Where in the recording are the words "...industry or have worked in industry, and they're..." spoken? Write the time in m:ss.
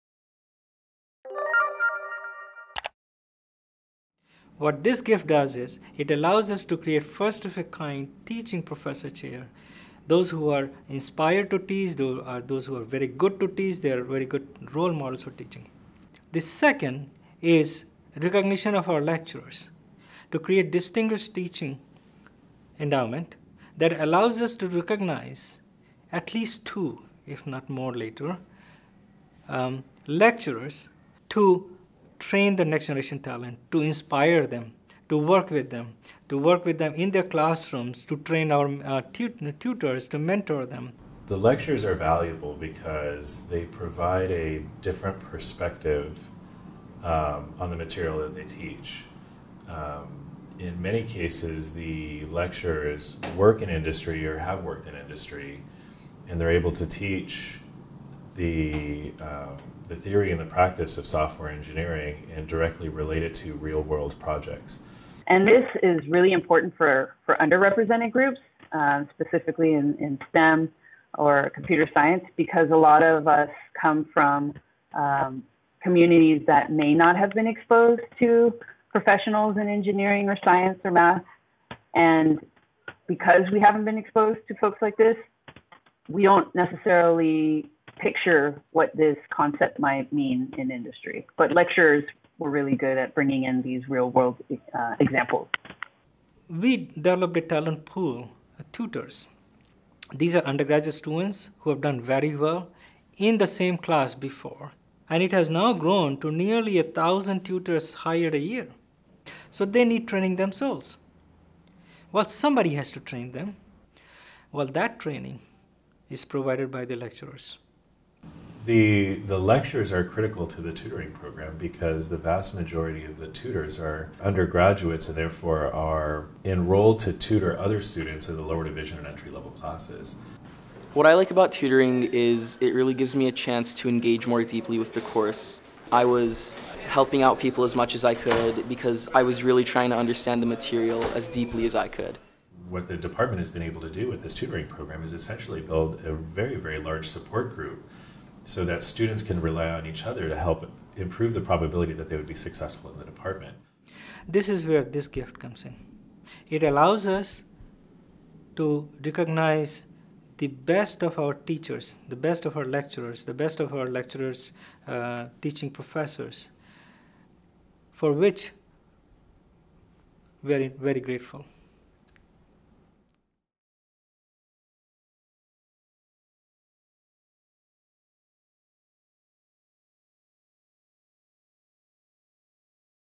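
0:53.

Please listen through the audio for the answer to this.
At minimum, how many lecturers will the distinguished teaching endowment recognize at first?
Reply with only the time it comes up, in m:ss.
0:26.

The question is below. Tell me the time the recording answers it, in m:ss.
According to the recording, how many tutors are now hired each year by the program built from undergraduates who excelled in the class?
1:46.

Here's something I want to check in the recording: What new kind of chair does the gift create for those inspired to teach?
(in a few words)
Teaching professor chair.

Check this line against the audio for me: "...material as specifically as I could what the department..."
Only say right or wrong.
wrong.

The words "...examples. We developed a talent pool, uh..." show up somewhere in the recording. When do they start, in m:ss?
1:34.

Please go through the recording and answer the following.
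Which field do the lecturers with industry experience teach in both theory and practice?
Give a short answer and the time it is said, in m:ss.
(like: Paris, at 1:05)
Software engineering, at 1:01.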